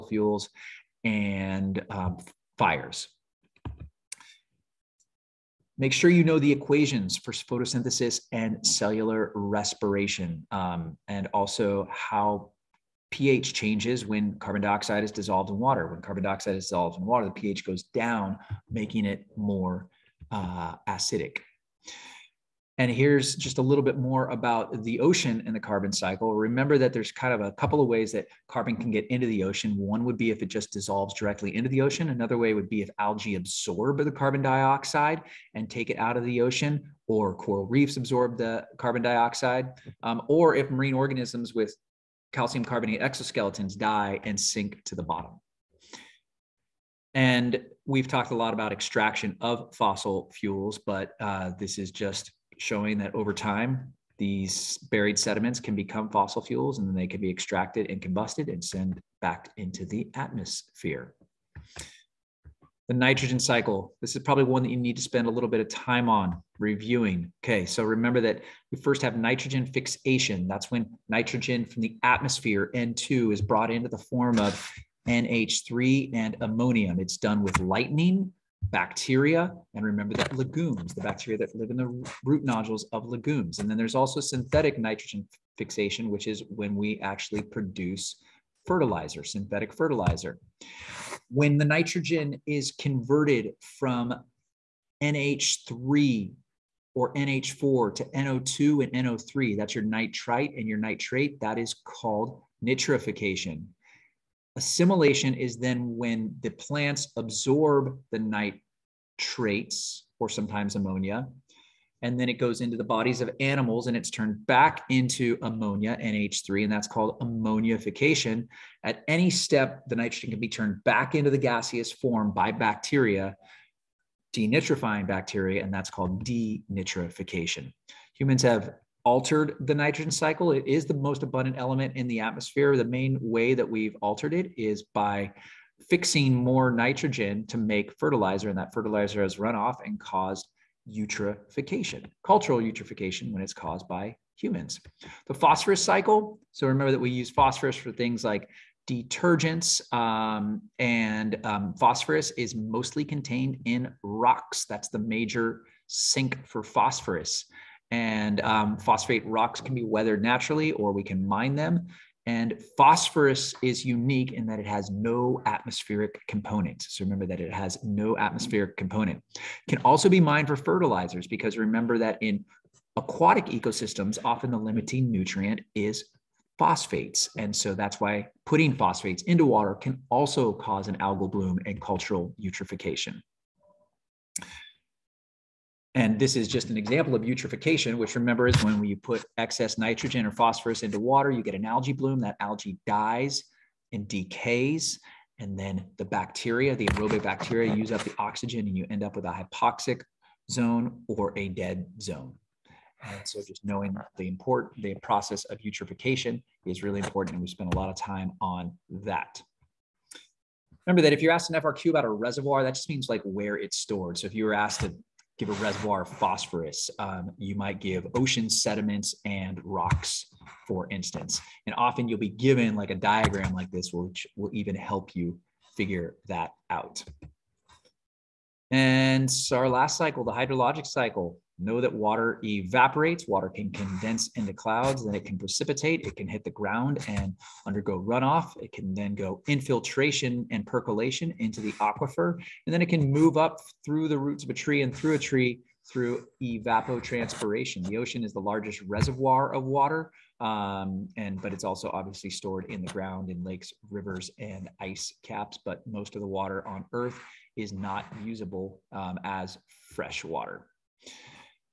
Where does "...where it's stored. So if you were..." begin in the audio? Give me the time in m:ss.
3:33.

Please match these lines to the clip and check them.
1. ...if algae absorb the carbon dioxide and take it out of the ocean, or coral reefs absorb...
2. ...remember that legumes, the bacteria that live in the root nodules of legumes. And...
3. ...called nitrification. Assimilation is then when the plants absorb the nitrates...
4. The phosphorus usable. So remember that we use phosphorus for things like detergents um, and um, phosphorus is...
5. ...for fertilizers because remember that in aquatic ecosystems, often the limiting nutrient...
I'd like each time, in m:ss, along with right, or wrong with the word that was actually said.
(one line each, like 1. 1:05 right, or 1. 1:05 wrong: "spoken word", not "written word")
1. 0:32 right
2. 1:19 right
3. 1:41 right
4. 2:25 wrong: "cycle", not "usable"
5. 2:50 right.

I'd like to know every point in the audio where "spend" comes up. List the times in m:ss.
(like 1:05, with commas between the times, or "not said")
1:05, 3:27.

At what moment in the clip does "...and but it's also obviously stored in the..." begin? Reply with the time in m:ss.
4:11.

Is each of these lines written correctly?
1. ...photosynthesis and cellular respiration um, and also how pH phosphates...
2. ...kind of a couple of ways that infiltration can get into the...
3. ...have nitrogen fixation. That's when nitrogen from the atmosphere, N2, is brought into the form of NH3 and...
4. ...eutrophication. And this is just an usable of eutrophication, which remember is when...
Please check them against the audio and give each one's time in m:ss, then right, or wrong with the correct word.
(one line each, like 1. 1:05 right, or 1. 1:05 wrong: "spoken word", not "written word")
1. 0:07 wrong: "changes", not "phosphates"
2. 0:27 wrong: "carbon", not "infiltration"
3. 1:09 right
4. 3:02 wrong: "example", not "usable".